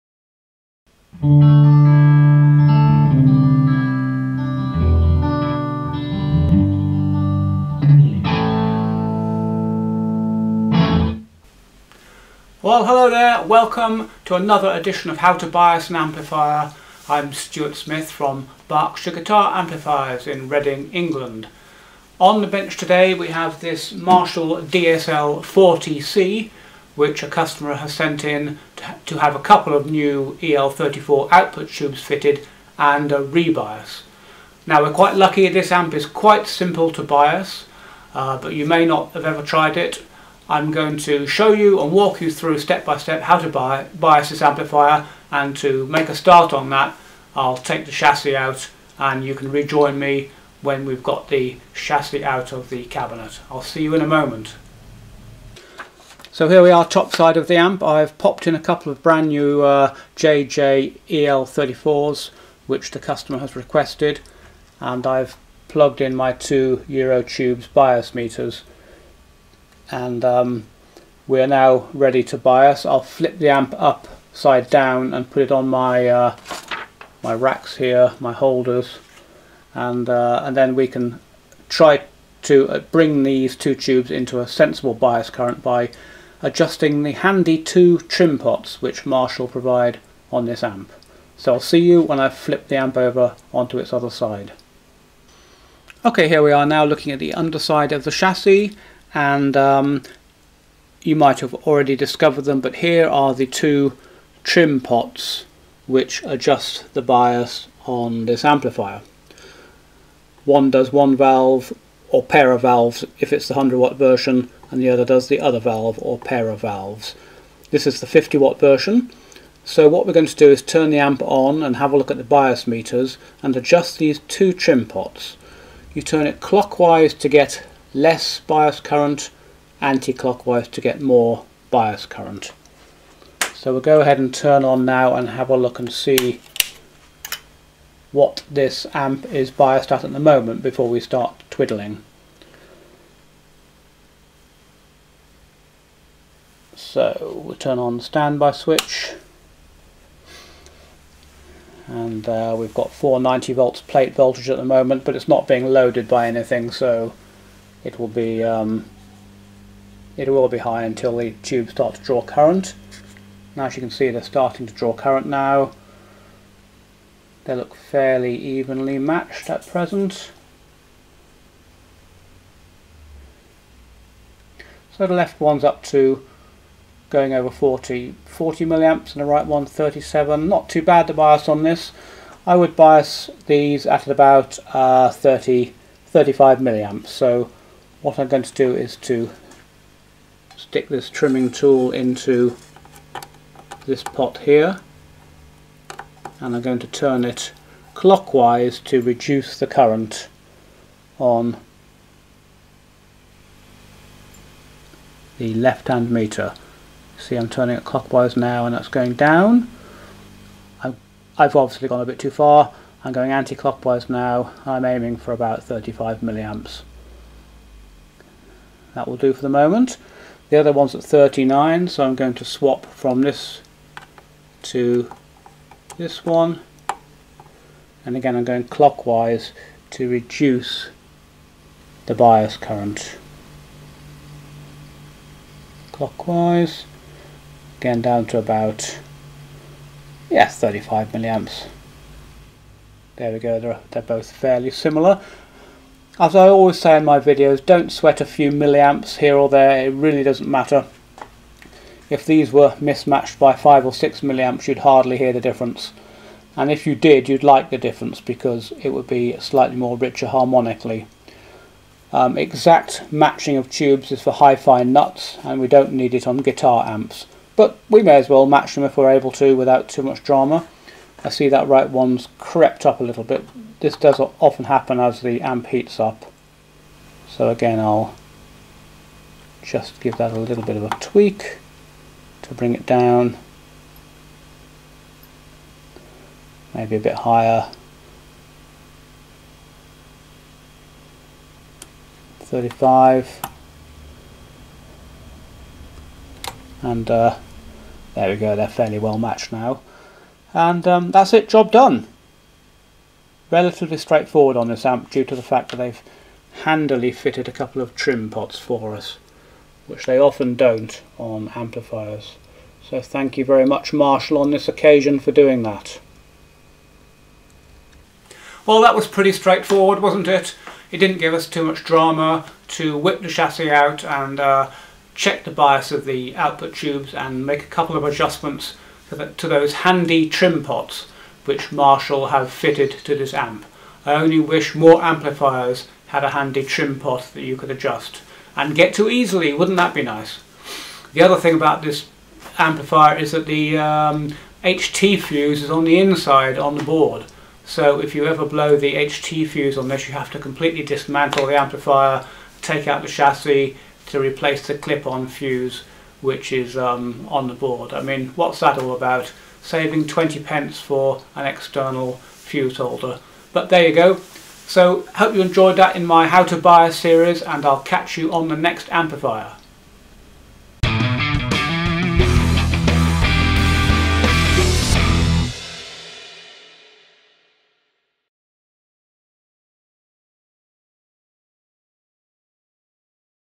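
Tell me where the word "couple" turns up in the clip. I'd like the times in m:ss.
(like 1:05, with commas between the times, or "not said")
0:29, 0:58, 5:07, 5:27.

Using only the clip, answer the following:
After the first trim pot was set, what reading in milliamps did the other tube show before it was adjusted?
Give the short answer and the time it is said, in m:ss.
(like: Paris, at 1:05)
39, at 3:41.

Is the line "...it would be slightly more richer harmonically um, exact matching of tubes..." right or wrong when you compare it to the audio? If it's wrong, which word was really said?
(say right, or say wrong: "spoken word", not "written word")
right.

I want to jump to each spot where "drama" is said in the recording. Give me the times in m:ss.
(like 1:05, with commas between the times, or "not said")
4:30, 5:21.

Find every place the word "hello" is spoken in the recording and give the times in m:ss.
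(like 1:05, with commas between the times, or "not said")
0:12.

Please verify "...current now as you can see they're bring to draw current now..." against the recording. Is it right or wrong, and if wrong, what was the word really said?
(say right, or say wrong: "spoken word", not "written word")
wrong: "starting", not "bring".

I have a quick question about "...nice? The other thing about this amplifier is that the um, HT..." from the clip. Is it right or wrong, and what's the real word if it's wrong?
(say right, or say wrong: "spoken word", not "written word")
right.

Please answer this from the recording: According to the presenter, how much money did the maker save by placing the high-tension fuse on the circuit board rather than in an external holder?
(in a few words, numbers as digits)
20 pence.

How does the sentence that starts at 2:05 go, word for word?
You turn it clockwise to get less bias current, anti-clockwise to get more bias current.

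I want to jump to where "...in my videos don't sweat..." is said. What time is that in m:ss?
4:06.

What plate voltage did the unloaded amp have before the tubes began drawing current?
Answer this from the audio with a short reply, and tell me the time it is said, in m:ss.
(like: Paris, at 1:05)
490 volts, at 2:32.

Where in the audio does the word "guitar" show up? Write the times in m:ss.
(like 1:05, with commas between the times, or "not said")
0:19, 4:26.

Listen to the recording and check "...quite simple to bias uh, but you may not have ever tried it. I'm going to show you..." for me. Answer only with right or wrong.
right.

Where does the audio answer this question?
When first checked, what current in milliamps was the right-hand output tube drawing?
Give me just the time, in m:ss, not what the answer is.
2:59.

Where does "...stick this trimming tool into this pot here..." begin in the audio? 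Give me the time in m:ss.
3:10.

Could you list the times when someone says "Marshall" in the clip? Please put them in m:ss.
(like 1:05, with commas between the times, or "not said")
0:23, 1:29, 5:13, 5:31.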